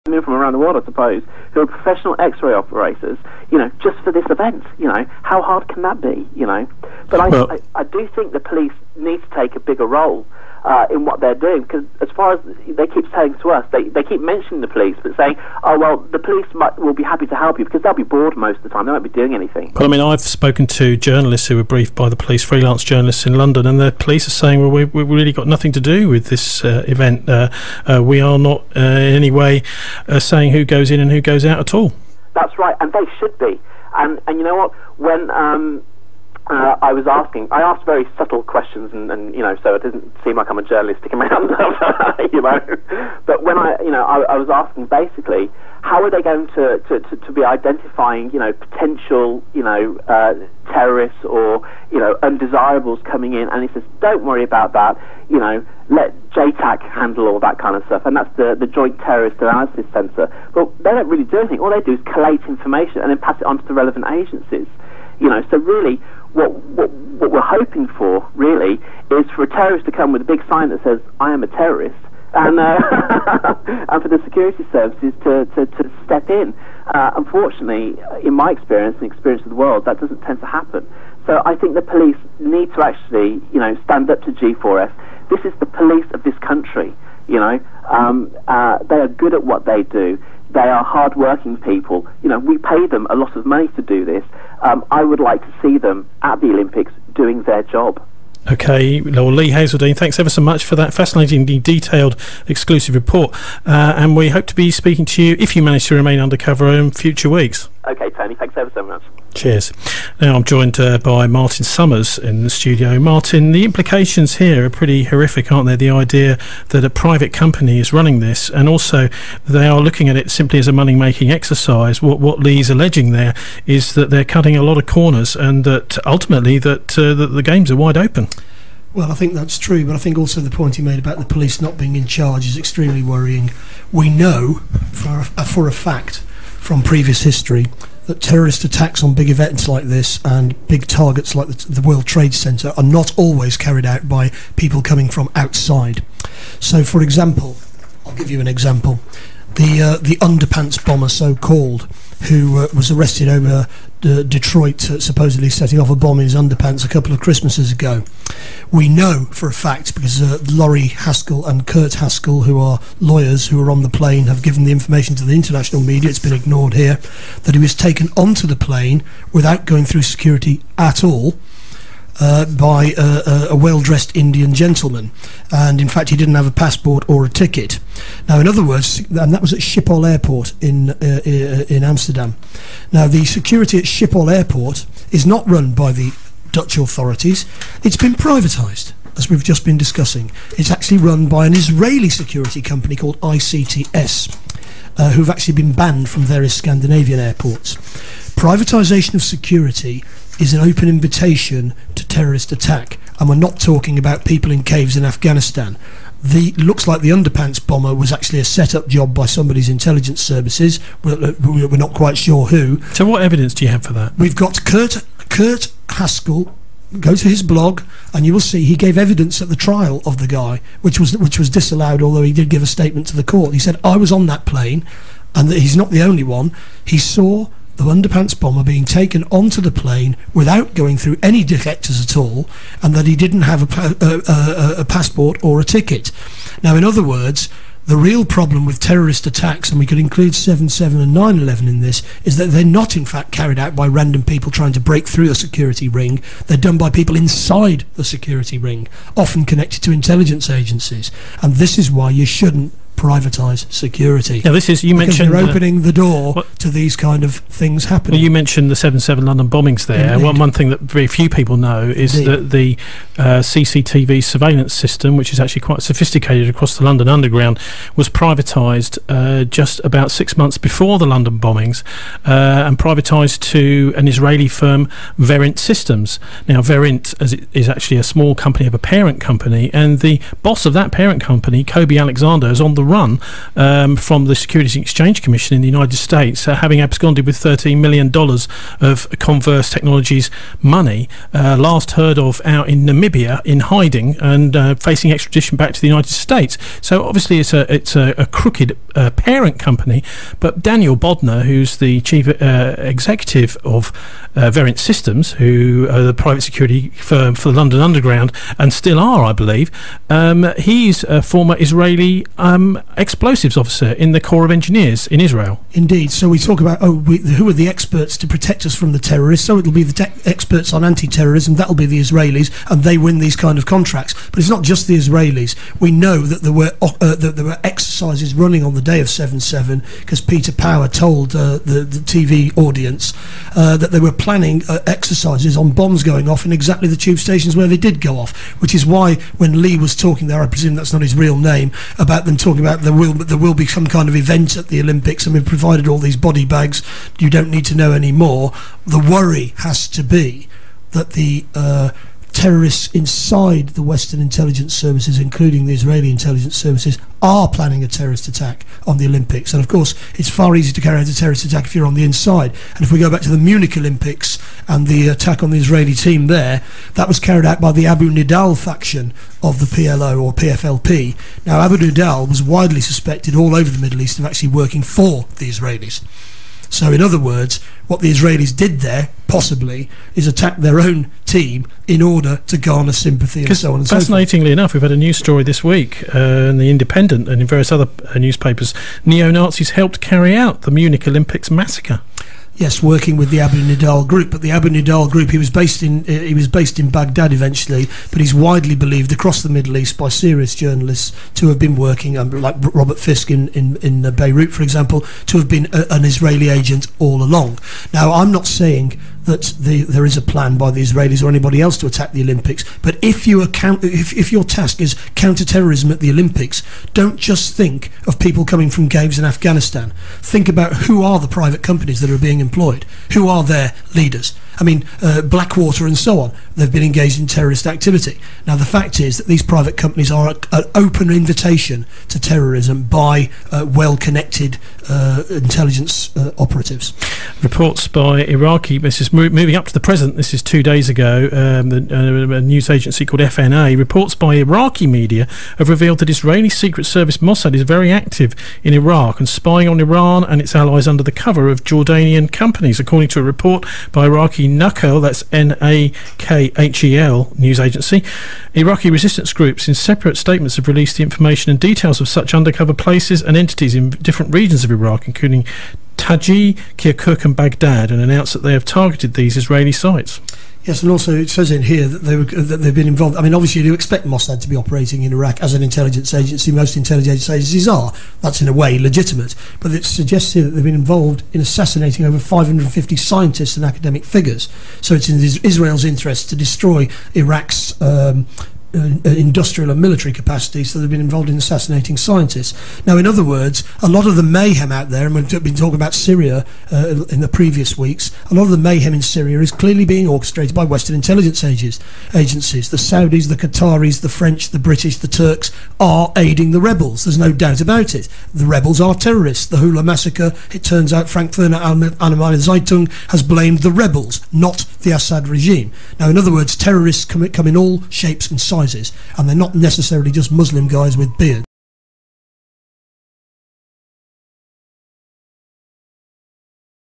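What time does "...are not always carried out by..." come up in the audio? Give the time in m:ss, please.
2:22.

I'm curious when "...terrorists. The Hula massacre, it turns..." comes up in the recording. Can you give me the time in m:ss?
8:28.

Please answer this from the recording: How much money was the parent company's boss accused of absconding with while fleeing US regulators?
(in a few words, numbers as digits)
$13 million.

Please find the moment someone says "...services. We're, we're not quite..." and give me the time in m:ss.
3:30.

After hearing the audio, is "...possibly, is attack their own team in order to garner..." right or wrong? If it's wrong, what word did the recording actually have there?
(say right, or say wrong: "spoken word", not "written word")
right.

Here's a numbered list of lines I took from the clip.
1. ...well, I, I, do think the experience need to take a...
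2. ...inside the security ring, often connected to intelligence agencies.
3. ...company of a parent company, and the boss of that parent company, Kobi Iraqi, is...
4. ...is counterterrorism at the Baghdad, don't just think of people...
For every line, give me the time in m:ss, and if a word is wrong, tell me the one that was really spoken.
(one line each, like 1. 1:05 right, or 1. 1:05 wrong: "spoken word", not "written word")
1. 0:07 wrong: "police", not "experience"
2. 4:07 right
3. 4:38 wrong: "Alexander", not "Iraqi"
4. 6:54 wrong: "Olympics", not "Baghdad".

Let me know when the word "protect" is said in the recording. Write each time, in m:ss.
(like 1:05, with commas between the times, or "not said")
5:18.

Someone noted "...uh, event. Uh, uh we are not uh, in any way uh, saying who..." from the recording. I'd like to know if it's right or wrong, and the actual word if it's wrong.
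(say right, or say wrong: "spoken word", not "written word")
right.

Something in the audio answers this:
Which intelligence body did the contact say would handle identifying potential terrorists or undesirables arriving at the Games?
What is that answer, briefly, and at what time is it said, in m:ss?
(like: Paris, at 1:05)
JTAC, at 0:56.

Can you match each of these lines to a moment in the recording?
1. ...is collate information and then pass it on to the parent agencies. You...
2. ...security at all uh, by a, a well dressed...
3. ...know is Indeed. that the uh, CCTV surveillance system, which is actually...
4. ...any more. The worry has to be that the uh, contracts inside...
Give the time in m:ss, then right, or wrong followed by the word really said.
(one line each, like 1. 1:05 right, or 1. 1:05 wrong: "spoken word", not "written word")
1. 1:01 wrong: "relevant", not "parent"
2. 2:50 right
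3. 4:21 right
4. 5:47 wrong: "terrorists", not "contracts".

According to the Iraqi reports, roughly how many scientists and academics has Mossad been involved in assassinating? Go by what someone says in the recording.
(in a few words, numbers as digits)
over 550.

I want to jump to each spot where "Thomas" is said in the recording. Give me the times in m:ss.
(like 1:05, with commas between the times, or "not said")
not said.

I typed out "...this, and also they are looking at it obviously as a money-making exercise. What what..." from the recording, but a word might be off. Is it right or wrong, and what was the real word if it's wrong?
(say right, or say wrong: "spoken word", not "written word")
wrong: "simply", not "obviously".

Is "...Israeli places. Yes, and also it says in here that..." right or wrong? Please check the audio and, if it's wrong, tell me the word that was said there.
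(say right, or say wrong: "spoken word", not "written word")
wrong: "sites", not "places".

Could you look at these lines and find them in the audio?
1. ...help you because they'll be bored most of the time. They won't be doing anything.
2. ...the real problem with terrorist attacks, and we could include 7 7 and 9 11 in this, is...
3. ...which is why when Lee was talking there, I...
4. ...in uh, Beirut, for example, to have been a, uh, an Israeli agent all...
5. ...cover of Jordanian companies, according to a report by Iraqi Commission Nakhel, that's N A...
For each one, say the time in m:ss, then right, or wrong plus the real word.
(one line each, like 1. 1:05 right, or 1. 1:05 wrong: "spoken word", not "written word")
1. 0:17 right
2. 3:57 right
3. 5:38 right
4. 6:43 right
5. 7:31 wrong: "Iraqi", not "Commission".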